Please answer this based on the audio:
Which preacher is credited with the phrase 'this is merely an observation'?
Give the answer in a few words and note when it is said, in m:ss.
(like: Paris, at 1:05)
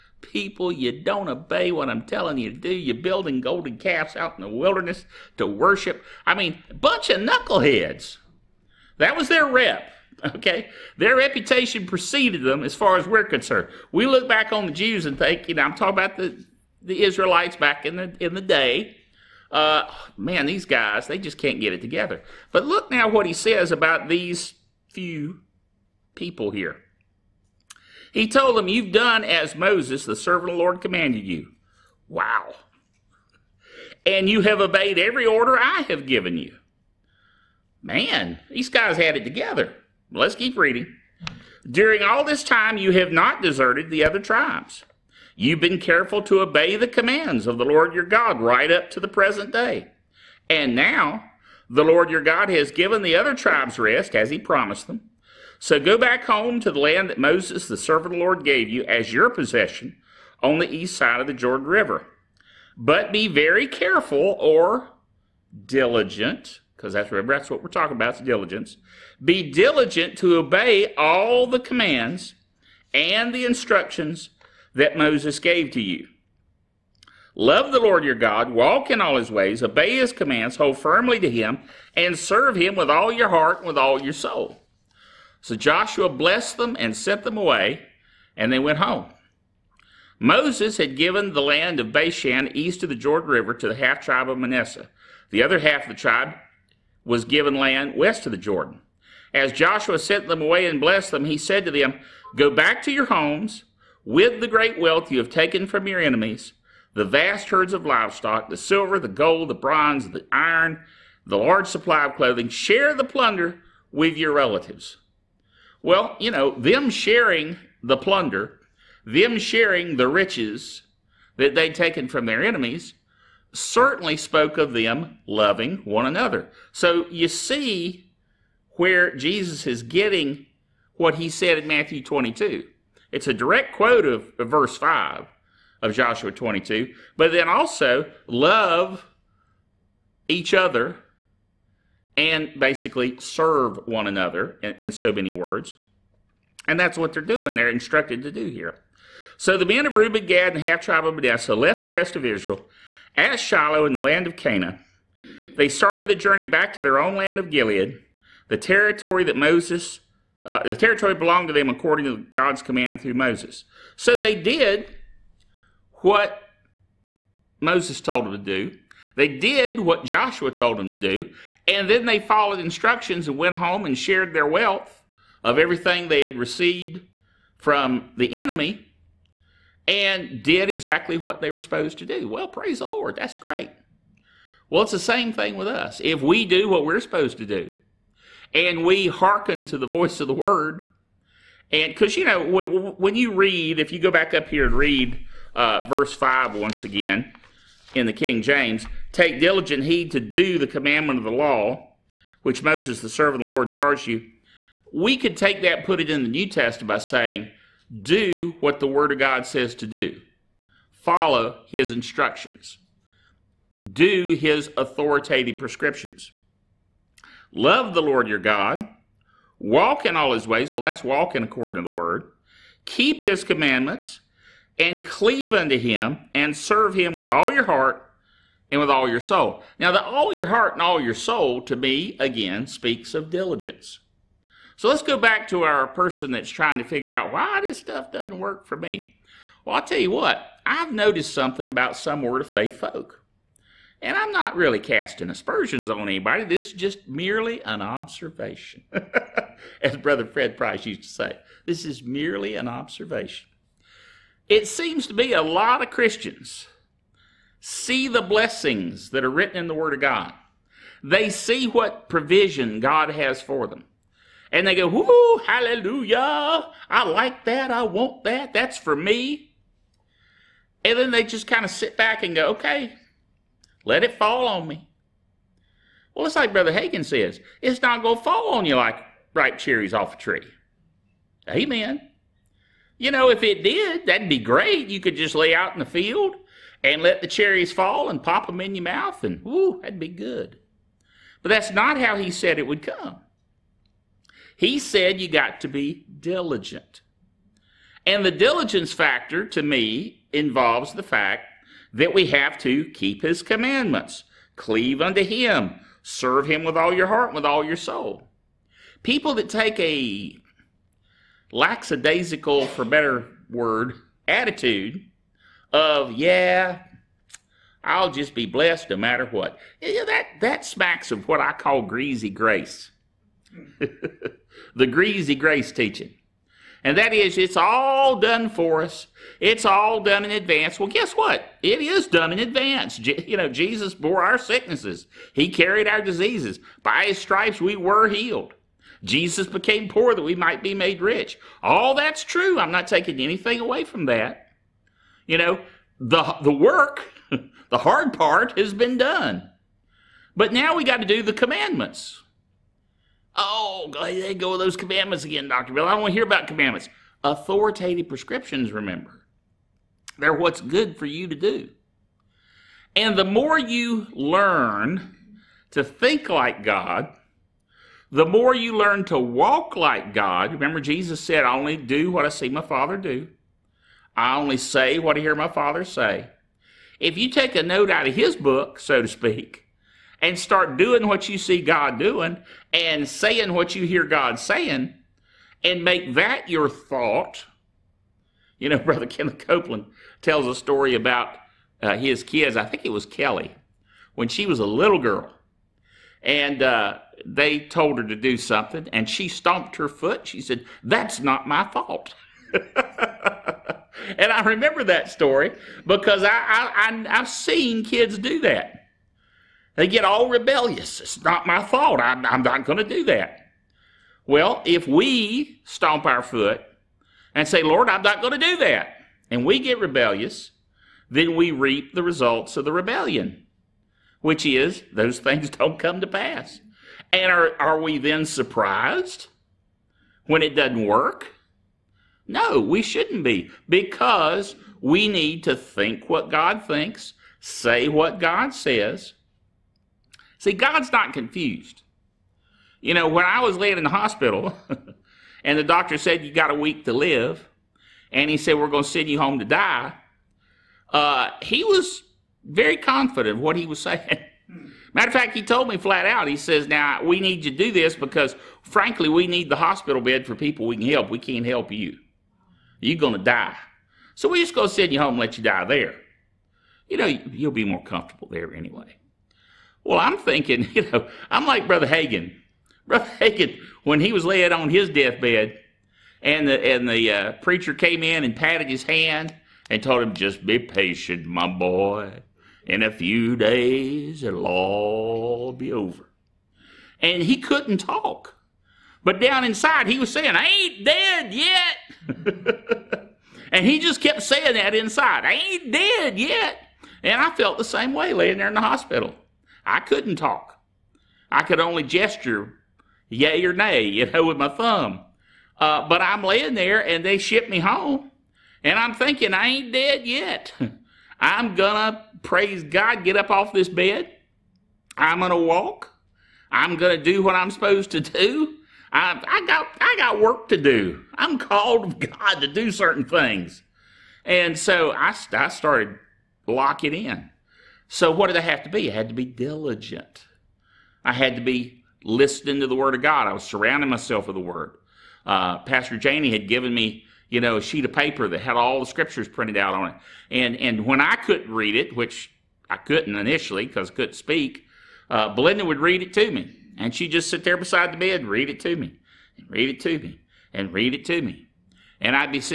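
Fred Price, at 4:09.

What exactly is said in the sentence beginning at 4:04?
And I'm not really casting aspersions on anybody.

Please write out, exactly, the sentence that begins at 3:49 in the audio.
Now, the all your heart and all your soul, to me, again, speaks of diligence.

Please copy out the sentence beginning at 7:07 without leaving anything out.
And are, are we then surprised when it doesn't work?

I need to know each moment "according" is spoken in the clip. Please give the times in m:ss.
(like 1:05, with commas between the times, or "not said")
2:41, 3:41.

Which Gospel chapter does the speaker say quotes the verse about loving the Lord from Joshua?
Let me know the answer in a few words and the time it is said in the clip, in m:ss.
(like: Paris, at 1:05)
Matthew 22, at 2:11.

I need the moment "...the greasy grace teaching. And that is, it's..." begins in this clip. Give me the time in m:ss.
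5:24.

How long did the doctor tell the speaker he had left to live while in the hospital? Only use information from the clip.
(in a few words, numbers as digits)
a week.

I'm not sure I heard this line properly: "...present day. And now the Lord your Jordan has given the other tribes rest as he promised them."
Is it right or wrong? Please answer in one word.
wrong.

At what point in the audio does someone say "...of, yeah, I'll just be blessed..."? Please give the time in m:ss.
5:15.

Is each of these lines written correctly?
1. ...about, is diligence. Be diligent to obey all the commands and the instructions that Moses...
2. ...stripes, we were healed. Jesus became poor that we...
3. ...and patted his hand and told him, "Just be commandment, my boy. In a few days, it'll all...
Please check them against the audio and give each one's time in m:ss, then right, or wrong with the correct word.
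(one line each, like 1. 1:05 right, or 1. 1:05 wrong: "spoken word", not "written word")
1. 1:07 right
2. 5:37 right
3. 7:58 wrong: "patient", not "commandment".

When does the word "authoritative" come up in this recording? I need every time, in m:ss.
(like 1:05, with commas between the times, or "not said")
3:34, 5:57.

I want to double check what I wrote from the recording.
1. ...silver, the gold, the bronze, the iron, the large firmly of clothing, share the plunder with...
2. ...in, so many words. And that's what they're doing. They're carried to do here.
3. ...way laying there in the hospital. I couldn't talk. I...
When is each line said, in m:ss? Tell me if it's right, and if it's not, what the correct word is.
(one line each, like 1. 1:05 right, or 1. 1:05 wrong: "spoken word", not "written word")
1. 1:48 wrong: "supply", not "firmly"
2. 2:24 wrong: "instructed", not "carried"
3. 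8:17 right.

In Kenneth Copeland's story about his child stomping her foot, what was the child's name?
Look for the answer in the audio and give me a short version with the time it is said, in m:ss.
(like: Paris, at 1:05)
Kelly, at 6:33.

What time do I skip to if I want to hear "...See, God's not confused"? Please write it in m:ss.
7:20.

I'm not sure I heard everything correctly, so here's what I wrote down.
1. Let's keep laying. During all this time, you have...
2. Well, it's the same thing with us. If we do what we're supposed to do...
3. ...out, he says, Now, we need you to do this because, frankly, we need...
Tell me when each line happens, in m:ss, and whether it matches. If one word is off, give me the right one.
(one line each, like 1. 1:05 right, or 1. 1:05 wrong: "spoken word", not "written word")
1. 0:40 wrong: "reading", not "laying"
2. 3:04 right
3. 7:36 right.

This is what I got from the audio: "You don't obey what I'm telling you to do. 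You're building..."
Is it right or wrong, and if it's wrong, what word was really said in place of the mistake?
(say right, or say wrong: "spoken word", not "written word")
right.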